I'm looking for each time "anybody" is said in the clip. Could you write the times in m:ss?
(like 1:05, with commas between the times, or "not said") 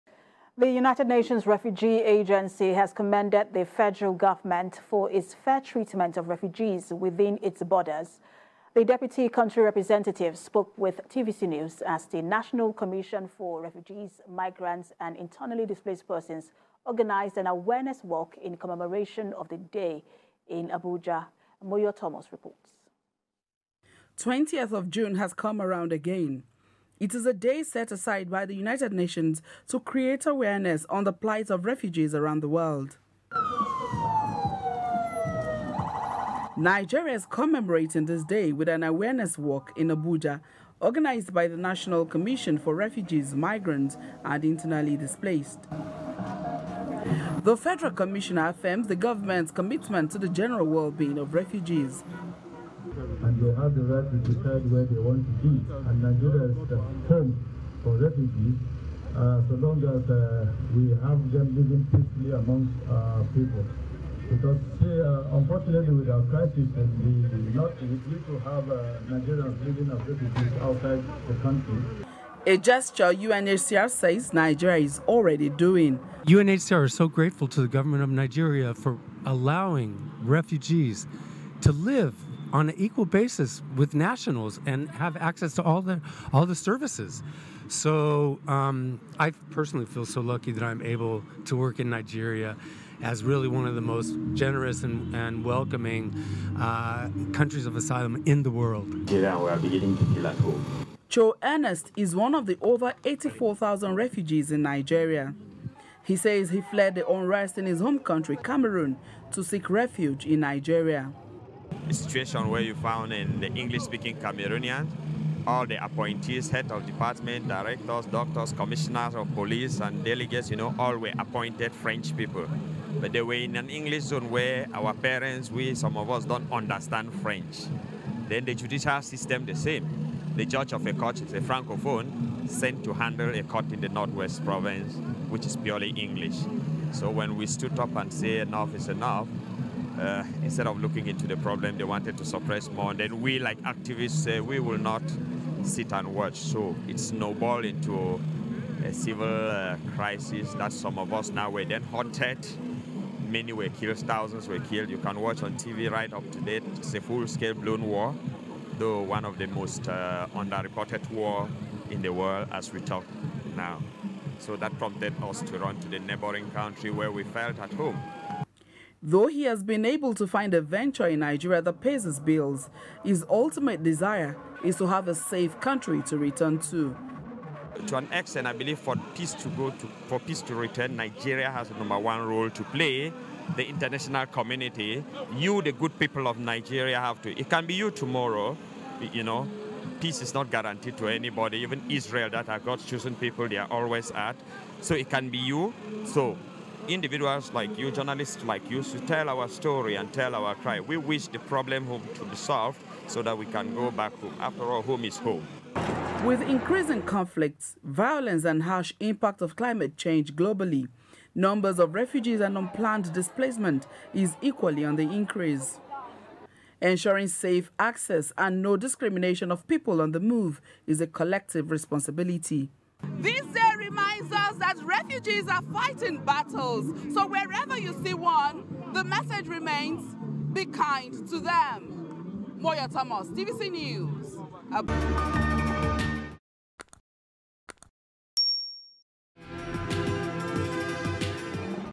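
3:11.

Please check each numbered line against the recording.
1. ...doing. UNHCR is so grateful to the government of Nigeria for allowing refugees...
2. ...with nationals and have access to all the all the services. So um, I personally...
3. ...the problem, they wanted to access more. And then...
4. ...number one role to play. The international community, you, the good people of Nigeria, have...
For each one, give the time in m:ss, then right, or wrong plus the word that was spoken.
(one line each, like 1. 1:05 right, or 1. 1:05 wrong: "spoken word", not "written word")
1. 1:15 right
2. 1:23 right
3. 2:21 wrong: "suppress", not "access"
4. 3:01 right.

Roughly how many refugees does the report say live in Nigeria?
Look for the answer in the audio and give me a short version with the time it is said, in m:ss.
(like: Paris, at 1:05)
84,000, at 1:43.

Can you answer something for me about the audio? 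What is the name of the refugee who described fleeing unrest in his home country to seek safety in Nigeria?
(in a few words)
Cho Ernest.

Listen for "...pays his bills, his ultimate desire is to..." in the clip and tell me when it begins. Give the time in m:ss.
2:51.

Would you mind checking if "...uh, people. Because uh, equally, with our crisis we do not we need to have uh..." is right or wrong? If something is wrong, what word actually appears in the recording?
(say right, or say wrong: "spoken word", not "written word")
wrong: "unfortunately", not "equally".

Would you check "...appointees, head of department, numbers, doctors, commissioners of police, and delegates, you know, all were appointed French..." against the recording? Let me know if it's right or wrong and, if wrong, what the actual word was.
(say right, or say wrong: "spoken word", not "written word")
wrong: "directors", not "numbers".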